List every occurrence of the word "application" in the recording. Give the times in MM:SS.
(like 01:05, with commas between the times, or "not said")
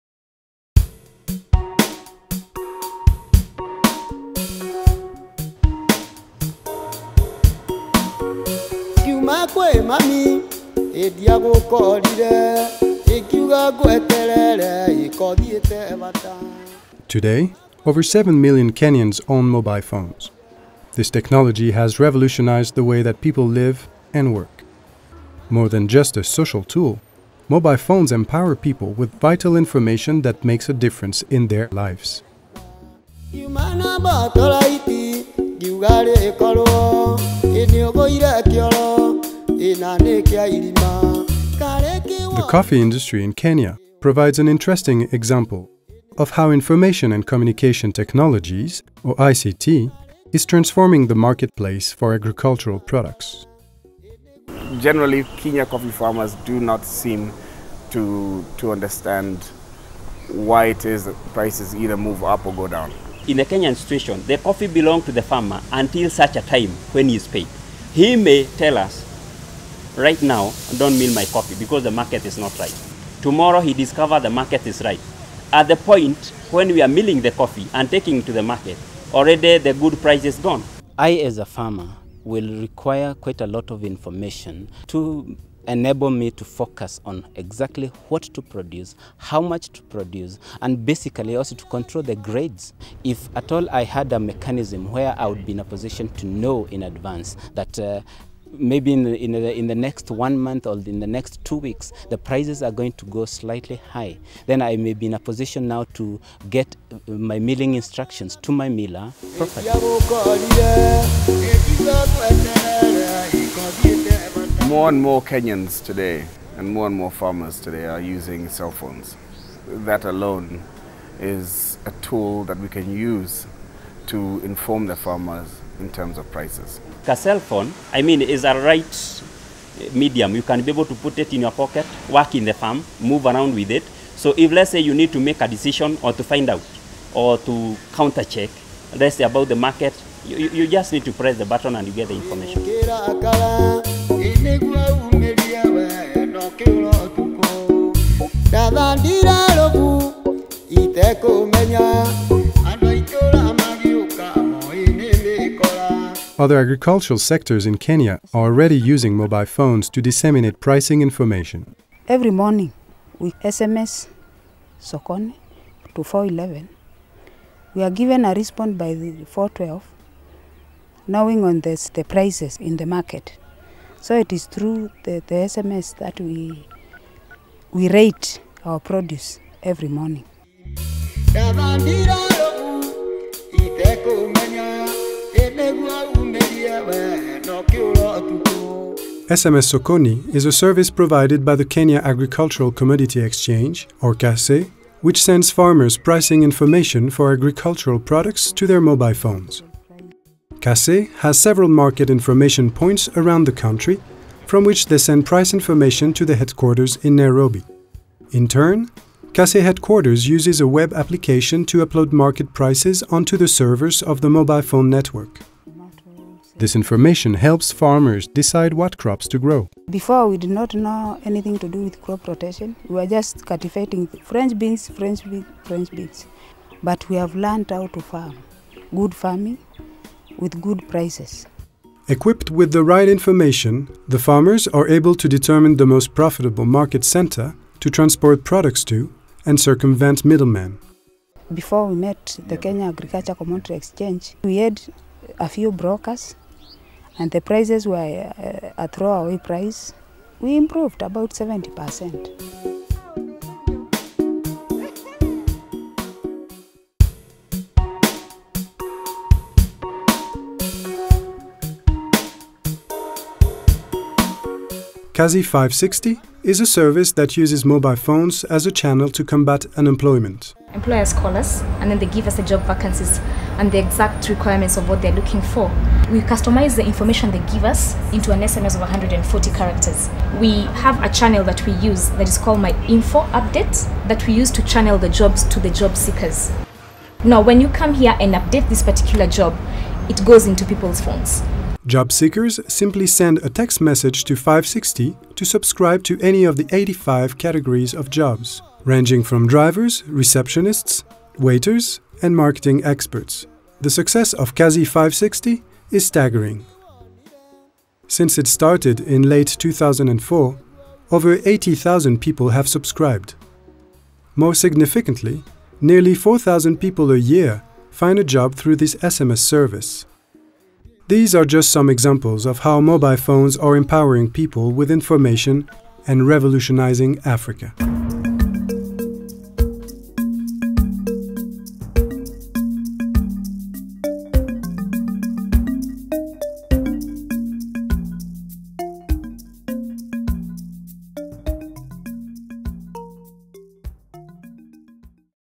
03:30.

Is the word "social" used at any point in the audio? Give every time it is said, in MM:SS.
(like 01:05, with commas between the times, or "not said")
00:26.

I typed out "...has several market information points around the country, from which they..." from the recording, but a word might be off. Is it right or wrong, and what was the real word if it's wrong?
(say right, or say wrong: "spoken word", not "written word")
right.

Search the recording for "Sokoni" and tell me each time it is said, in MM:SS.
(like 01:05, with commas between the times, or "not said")
02:44, 03:09.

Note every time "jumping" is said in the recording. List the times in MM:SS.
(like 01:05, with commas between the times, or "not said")
not said.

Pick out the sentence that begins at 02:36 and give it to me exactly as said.
Other agricultural sectors in Kenya are already using mobile phones to disseminate pricing information.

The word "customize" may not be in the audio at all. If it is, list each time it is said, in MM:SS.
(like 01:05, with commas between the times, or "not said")
04:36.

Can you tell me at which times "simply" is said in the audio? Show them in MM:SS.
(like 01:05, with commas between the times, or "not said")
04:52.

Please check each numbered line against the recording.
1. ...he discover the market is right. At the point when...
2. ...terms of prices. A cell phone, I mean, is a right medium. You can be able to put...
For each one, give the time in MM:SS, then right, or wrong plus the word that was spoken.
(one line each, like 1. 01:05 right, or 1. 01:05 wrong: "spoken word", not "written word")
1. 01:13 right
2. 02:05 right.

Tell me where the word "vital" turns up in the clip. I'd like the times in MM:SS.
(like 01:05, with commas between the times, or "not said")
00:29.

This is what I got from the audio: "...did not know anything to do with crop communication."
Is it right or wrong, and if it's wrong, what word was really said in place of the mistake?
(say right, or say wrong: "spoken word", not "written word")
wrong: "rotation", not "communication".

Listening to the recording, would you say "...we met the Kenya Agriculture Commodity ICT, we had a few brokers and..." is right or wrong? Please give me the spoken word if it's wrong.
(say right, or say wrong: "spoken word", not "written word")
wrong: "Exchange", not "ICT".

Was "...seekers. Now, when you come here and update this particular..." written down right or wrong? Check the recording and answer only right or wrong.
right.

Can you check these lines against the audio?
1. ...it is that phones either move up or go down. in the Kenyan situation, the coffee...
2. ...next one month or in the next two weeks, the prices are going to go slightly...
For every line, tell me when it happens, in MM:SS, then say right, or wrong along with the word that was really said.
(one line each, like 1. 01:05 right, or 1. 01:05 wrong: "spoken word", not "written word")
1. 01:00 wrong: "prices", not "phones"
2. 01:39 right.